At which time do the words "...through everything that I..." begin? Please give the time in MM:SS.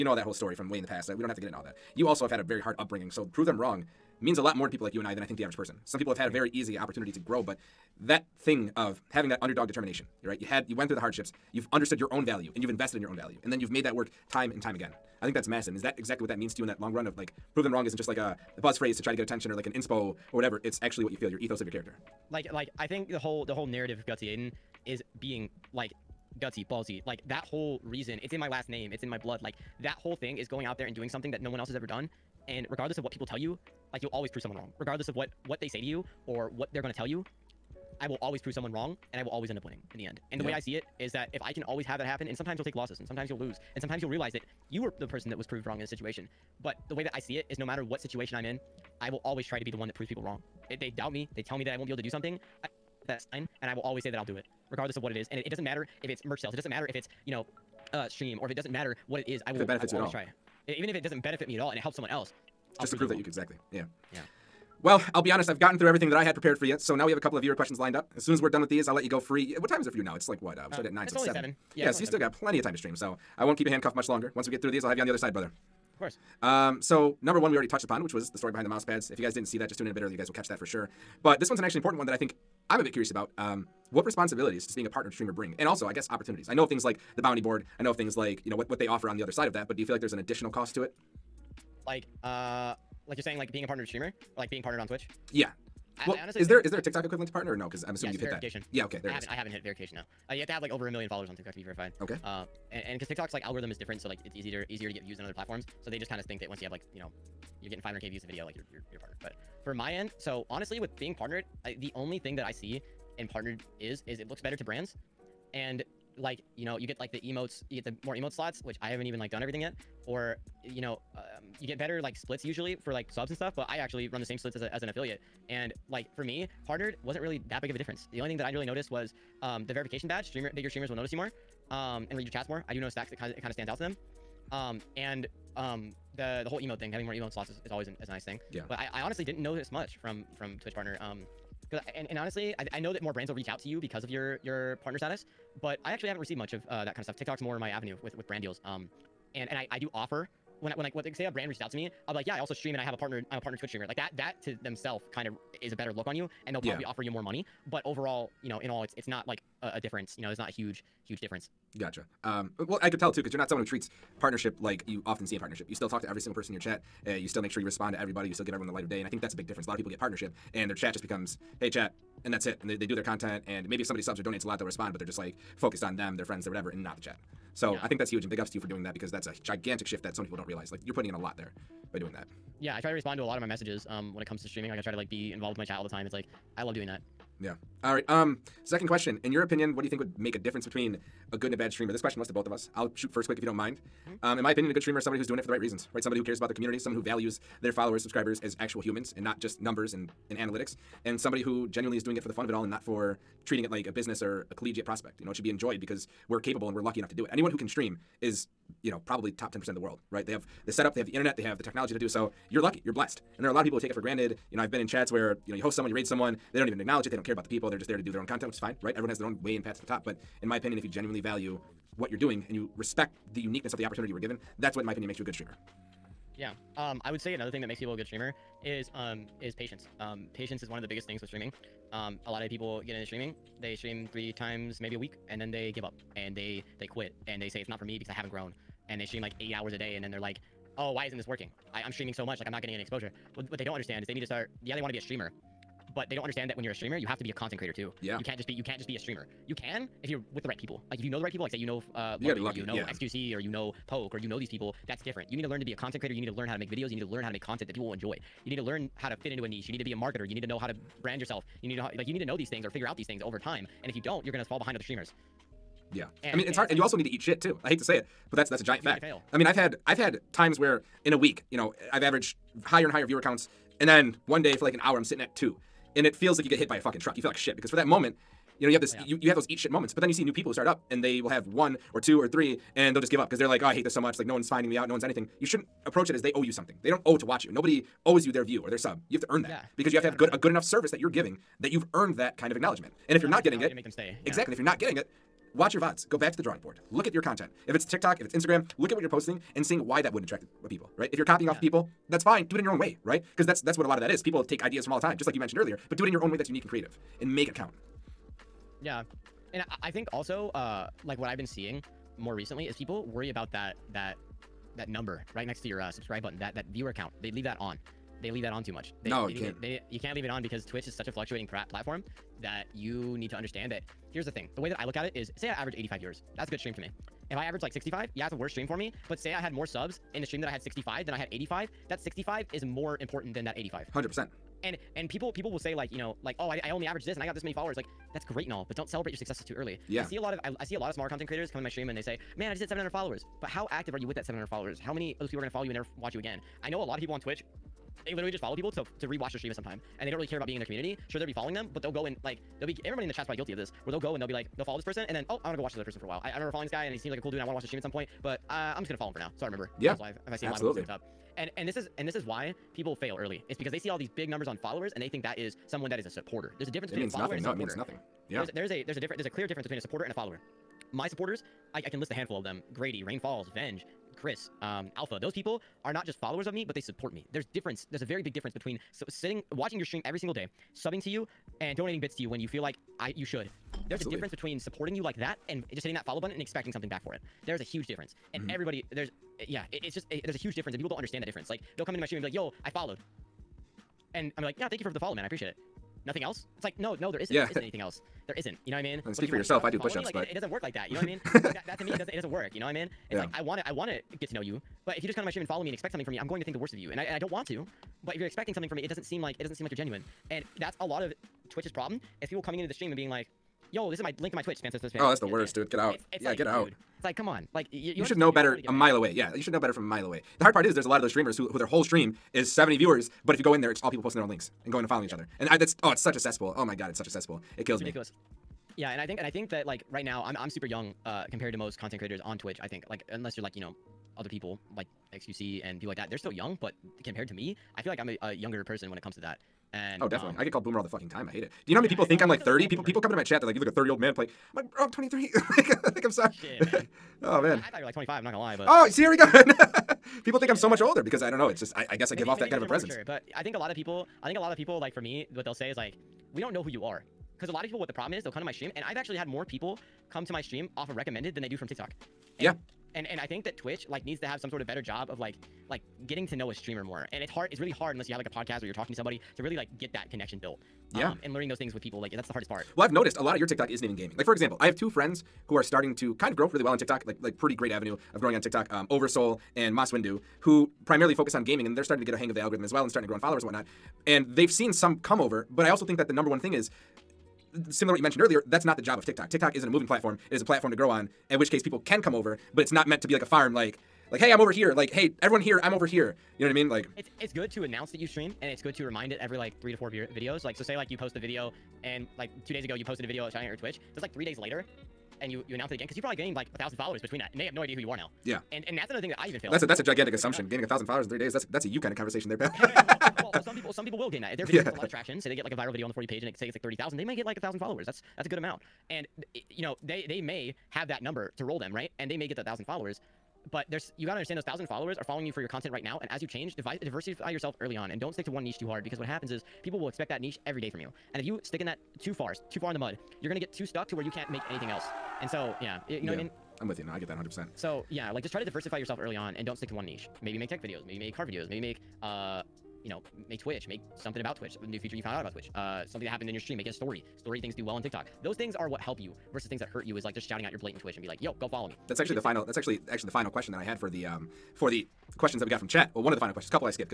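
01:05.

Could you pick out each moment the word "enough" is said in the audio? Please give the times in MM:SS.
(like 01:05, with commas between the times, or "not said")
03:26, 04:50.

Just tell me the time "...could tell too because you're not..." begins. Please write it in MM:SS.
02:42.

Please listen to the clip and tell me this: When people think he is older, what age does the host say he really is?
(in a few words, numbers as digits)
23.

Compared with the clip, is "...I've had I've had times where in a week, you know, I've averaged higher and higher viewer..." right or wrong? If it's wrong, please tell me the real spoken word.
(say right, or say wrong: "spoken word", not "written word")
right.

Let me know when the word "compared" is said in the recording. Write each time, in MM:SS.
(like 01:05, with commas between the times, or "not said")
07:11, 07:17.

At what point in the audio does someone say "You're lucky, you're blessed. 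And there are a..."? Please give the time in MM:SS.
03:32.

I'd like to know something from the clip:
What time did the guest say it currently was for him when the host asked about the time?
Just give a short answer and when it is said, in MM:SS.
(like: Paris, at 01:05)
7, at 01:11.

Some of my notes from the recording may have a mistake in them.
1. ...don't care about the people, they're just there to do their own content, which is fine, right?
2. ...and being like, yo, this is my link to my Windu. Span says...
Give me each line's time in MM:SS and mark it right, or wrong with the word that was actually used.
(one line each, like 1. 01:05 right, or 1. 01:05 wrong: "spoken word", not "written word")
1. 03:37 right
2. 06:52 wrong: "Twitch", not "Windu".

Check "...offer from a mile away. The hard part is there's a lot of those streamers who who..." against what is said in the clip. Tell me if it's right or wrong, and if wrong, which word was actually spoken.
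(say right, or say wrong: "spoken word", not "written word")
wrong: "better", not "offer".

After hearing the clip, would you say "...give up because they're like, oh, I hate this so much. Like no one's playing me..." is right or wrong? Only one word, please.
wrong.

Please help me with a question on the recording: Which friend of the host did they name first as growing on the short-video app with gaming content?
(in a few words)
Oversoul.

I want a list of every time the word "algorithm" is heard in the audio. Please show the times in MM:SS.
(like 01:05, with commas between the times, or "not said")
01:43, 08:02.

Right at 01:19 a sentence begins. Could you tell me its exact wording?
If you guys didn't see that, just tune in a bit earlier.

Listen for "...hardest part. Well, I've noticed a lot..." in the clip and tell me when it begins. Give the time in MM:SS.
07:52.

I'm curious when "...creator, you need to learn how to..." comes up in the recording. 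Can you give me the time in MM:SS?
04:15.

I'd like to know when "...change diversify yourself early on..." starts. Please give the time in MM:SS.
08:46.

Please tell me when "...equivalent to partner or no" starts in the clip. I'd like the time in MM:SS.
01:37.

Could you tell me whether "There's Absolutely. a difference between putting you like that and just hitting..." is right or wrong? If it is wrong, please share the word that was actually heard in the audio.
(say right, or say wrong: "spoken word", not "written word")
wrong: "supporting", not "putting".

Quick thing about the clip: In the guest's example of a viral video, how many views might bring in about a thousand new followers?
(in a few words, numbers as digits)
30,000.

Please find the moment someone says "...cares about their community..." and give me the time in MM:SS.
03:16.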